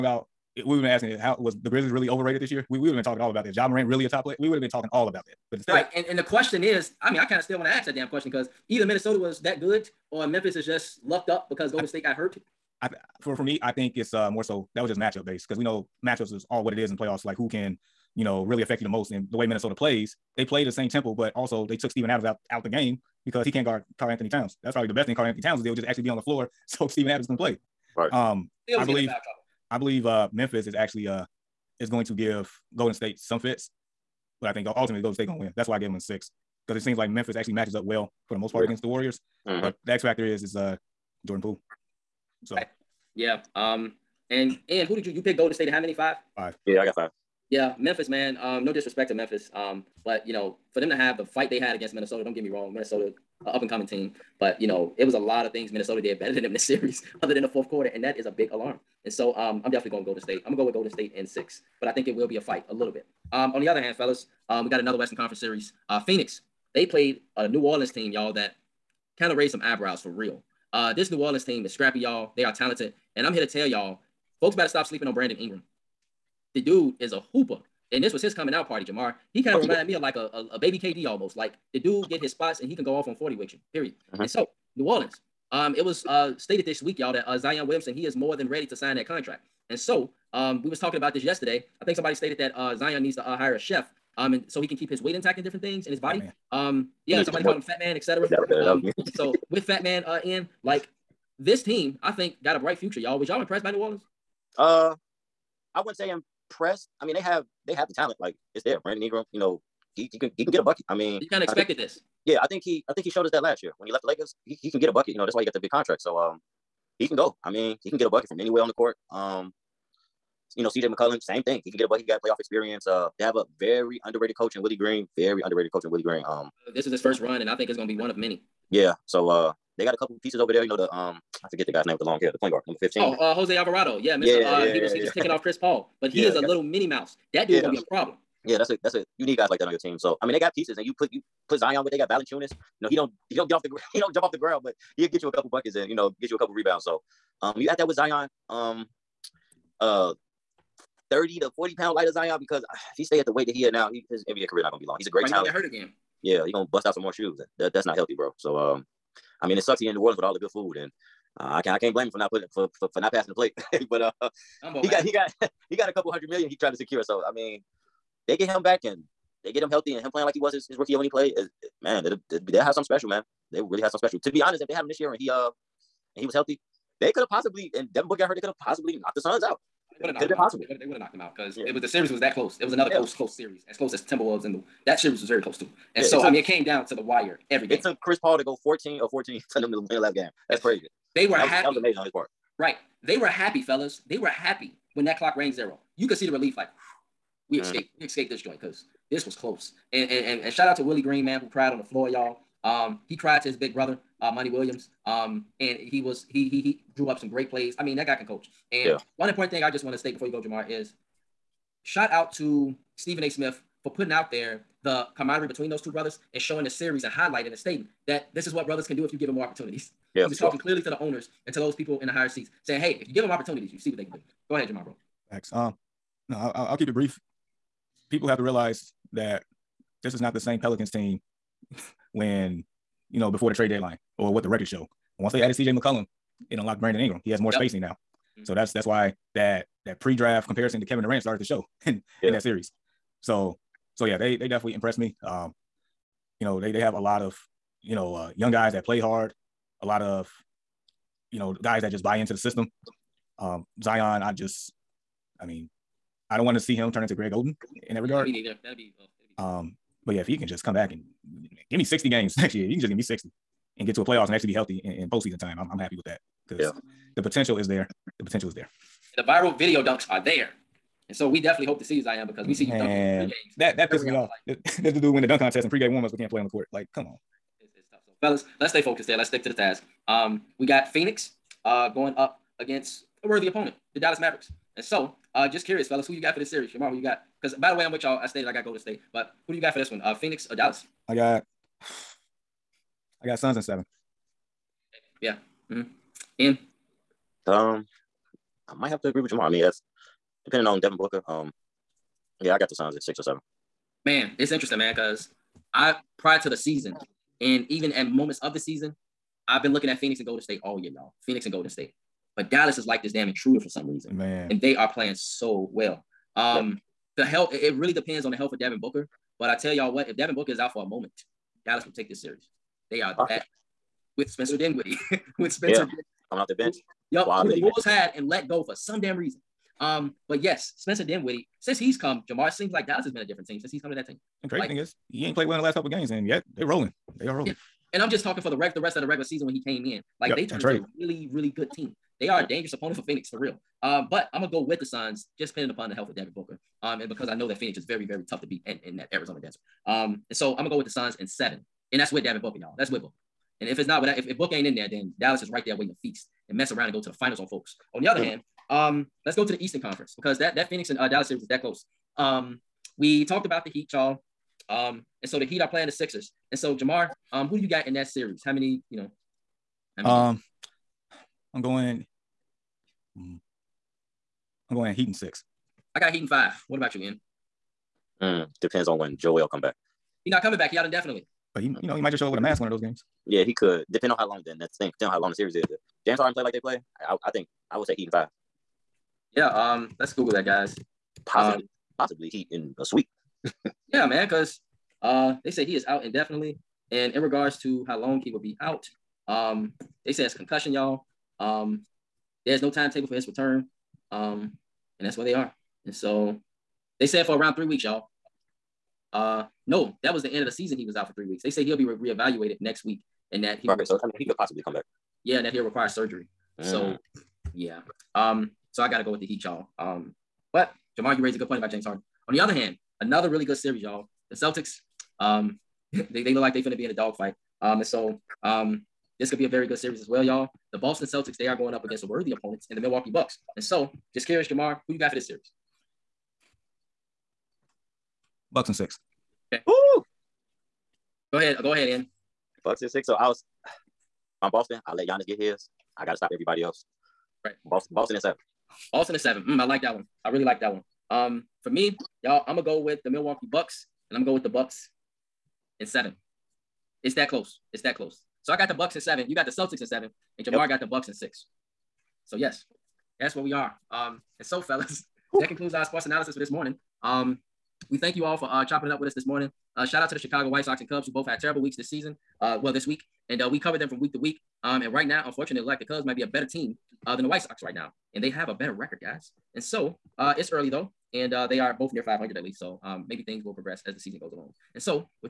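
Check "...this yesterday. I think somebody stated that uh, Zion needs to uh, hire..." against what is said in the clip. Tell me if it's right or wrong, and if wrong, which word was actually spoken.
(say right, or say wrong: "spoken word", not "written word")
right.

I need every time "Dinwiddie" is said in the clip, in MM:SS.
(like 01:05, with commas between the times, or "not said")
05:24, 05:31.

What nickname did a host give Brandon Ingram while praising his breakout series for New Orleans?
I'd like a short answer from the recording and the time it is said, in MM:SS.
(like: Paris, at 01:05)
Baby KD, at 01:20.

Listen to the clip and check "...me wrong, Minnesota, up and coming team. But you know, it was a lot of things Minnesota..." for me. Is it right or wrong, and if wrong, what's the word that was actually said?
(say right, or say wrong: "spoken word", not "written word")
right.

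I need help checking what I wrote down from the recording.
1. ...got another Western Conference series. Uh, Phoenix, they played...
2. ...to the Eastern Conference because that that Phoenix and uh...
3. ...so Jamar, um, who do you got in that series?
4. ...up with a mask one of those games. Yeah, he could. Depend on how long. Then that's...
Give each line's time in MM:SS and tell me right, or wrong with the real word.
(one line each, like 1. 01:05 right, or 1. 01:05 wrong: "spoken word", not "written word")
1. 01:04 right
2. 05:59 right
3. 06:06 right
4. 06:22 right.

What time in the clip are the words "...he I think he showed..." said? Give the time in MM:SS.
01:52.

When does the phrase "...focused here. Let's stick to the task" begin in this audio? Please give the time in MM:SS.
04:38.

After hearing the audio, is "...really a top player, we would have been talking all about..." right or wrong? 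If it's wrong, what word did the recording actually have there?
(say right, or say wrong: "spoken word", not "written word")
right.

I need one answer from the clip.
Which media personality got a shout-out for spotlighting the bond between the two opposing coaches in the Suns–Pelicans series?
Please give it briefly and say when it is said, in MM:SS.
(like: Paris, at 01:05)
Stephen A. Smith, at 03:32.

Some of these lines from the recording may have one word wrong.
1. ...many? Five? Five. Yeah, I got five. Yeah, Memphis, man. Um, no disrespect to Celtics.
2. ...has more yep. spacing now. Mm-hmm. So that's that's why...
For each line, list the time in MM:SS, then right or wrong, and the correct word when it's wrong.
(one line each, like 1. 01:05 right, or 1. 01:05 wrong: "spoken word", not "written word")
1. 00:45 wrong: "Memphis", not "Celtics"
2. 03:57 right.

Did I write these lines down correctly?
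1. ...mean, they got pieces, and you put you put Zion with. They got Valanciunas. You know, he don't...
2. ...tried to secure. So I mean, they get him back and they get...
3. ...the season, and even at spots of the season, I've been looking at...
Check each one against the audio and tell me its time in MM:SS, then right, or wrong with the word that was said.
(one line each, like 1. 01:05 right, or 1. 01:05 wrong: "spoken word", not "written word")
1. 02:20 right
2. 02:46 right
3. 05:06 wrong: "moments", not "spots".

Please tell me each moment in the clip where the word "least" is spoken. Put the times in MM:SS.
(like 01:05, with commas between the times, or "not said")
08:02.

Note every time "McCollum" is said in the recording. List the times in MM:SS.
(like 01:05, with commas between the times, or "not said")
02:00, 03:55.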